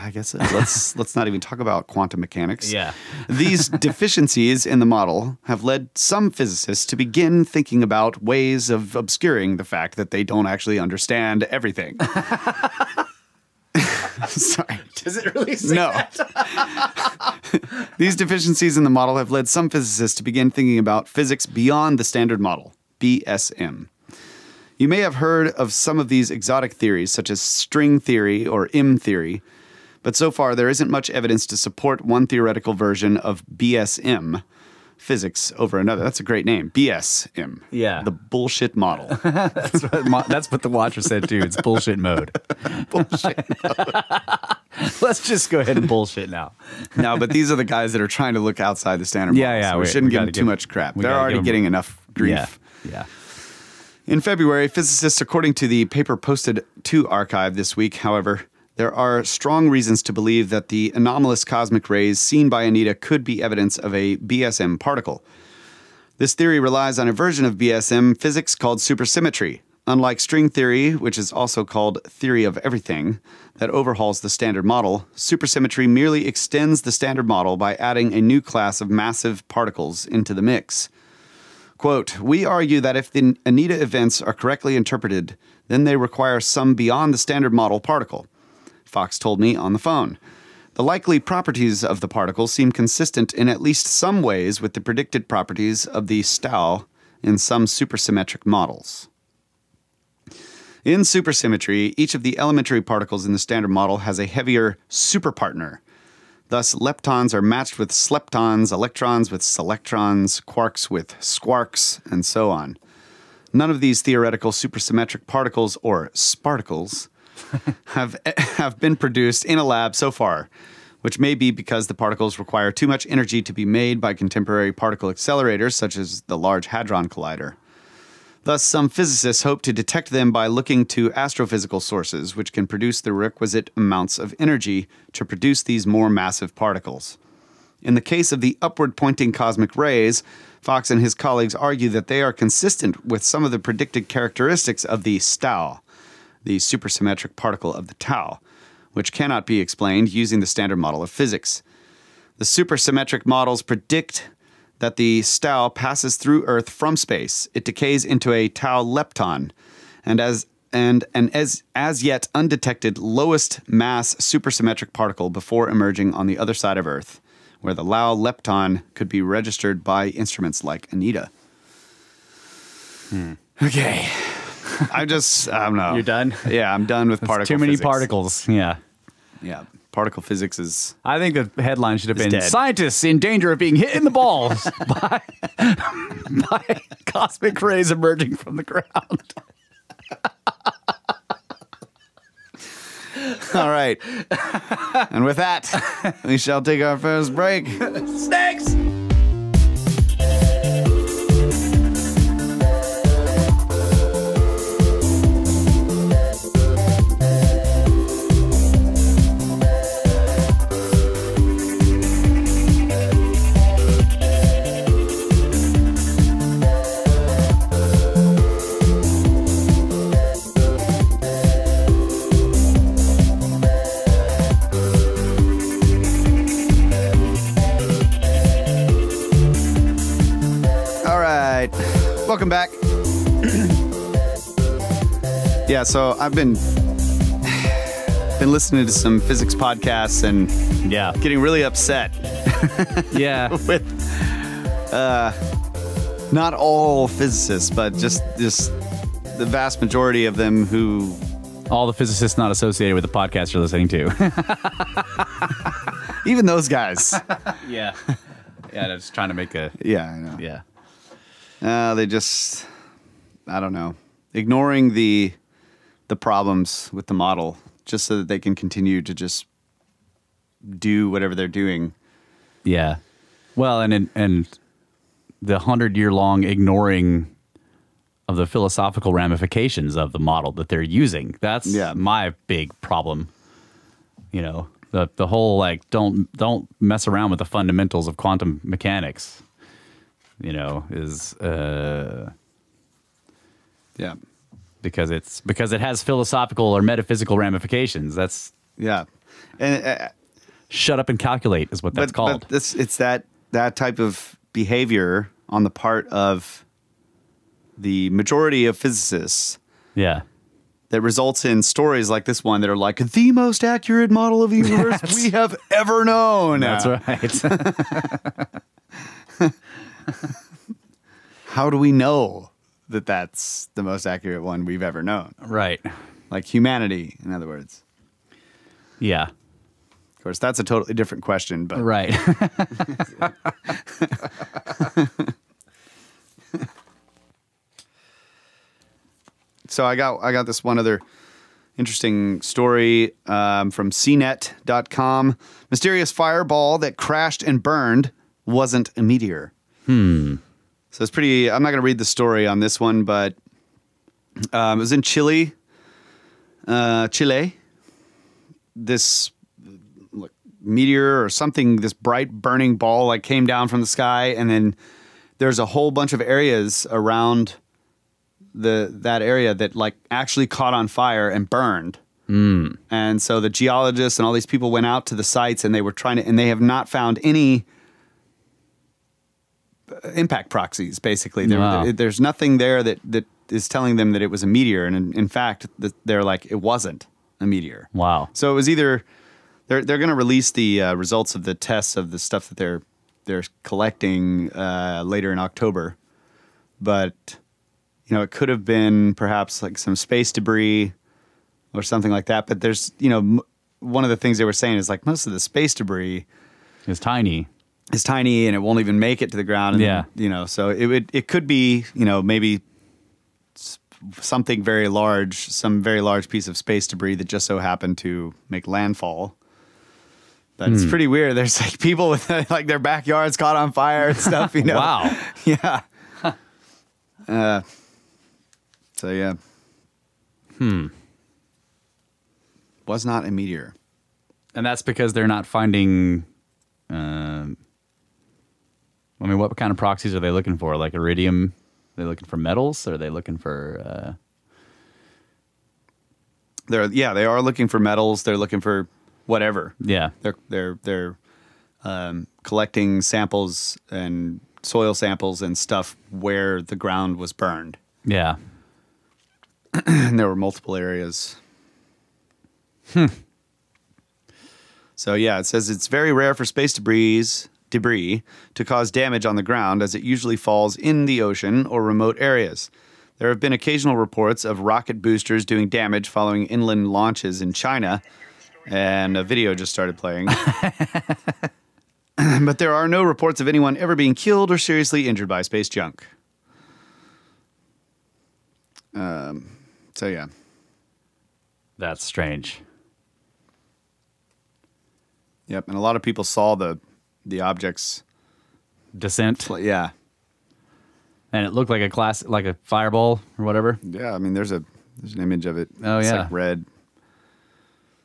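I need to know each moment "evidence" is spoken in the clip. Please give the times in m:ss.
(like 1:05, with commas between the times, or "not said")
0:31, 1:03.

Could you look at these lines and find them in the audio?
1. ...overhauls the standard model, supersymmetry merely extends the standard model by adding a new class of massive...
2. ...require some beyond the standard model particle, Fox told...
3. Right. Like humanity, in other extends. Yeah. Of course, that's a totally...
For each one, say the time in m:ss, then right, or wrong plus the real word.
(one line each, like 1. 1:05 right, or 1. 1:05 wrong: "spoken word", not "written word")
1. 1:13 right
2. 1:25 right
3. 5:25 wrong: "words", not "extends".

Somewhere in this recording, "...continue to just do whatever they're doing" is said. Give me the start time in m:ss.
4:28.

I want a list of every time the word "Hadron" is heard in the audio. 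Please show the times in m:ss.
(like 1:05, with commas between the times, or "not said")
2:06.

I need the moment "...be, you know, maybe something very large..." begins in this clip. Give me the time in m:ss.
6:51.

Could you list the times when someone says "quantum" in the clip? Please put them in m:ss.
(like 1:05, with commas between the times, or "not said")
0:01, 4:48.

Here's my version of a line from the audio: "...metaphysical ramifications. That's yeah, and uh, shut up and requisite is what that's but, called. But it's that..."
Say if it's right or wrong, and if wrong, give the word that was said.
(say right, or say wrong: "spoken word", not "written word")
wrong: "calculate", not "requisite".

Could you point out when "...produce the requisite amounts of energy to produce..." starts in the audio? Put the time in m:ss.
2:12.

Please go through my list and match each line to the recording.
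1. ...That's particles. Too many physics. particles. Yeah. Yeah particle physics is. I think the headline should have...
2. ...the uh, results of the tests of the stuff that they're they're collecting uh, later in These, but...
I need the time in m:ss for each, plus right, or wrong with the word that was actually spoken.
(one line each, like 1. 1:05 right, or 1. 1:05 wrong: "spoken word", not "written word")
1. 2:57 right
2. 6:30 wrong: "October", not "These".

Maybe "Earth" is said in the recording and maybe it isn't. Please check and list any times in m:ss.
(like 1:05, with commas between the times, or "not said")
2:36, 2:46.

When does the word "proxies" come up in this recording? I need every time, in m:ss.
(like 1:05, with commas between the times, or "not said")
6:20, 7:19.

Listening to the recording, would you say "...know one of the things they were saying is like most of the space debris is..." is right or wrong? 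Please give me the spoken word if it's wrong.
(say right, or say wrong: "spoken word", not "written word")
right.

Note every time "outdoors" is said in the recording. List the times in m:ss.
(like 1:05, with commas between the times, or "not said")
not said.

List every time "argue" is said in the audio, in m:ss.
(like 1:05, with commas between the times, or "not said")
1:22, 2:21.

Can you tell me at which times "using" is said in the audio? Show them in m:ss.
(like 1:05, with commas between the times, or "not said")
2:30, 4:40.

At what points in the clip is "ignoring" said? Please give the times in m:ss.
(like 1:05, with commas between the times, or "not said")
4:24, 4:36.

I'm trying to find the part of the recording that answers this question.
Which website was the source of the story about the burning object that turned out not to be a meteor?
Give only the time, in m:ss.
5:43.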